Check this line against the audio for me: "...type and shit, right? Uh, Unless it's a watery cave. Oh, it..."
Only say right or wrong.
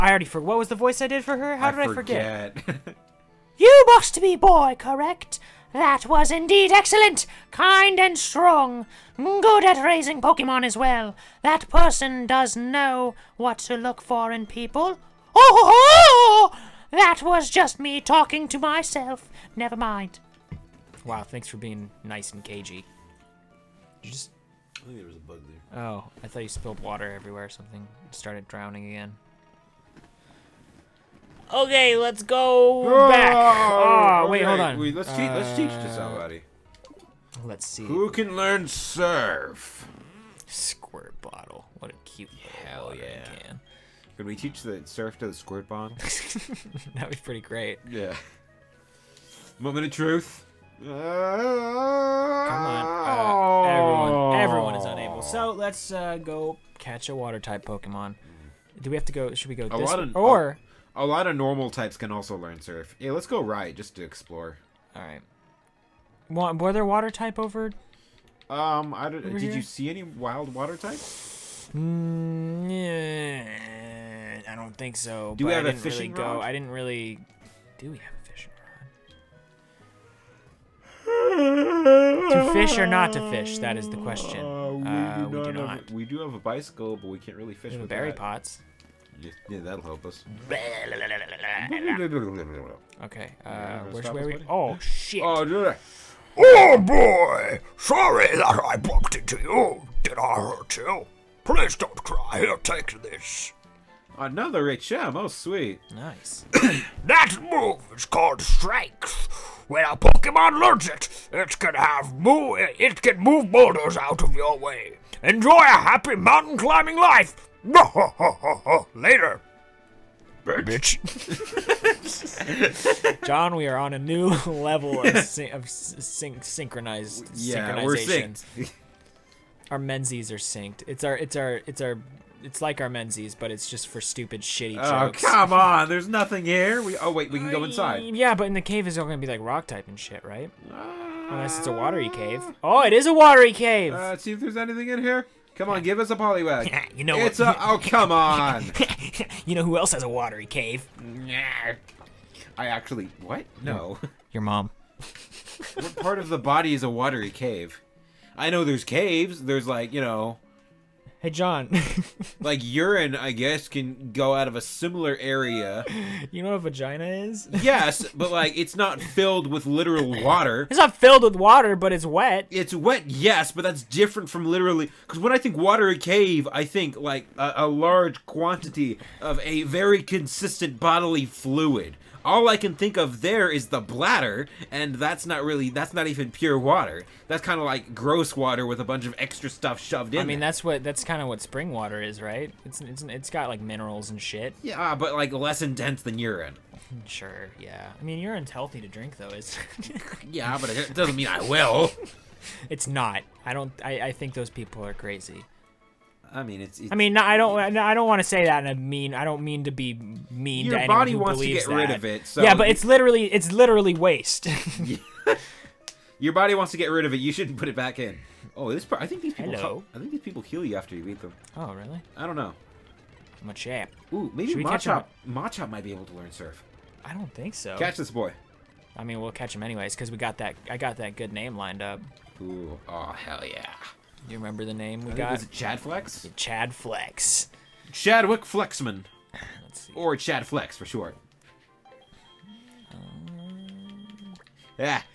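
right.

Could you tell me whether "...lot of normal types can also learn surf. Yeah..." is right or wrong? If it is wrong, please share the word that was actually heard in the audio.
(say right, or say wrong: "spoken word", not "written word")
right.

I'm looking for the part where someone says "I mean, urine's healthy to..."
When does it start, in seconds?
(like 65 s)
197 s.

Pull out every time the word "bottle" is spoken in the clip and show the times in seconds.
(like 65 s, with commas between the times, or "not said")
41 s.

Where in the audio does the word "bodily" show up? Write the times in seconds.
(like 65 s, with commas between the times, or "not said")
180 s.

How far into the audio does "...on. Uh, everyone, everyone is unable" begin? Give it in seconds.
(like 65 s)
50 s.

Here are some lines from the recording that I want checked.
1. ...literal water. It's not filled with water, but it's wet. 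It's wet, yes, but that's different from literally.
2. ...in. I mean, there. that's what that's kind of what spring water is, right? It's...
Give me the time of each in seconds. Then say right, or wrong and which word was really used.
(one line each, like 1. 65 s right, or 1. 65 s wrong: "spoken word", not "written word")
1. 169 s right
2. 190 s right.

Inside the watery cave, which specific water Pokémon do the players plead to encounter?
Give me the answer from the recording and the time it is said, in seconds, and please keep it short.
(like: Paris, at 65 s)
Poliwag, at 146 s.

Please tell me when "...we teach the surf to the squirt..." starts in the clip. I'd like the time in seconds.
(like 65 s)
44 s.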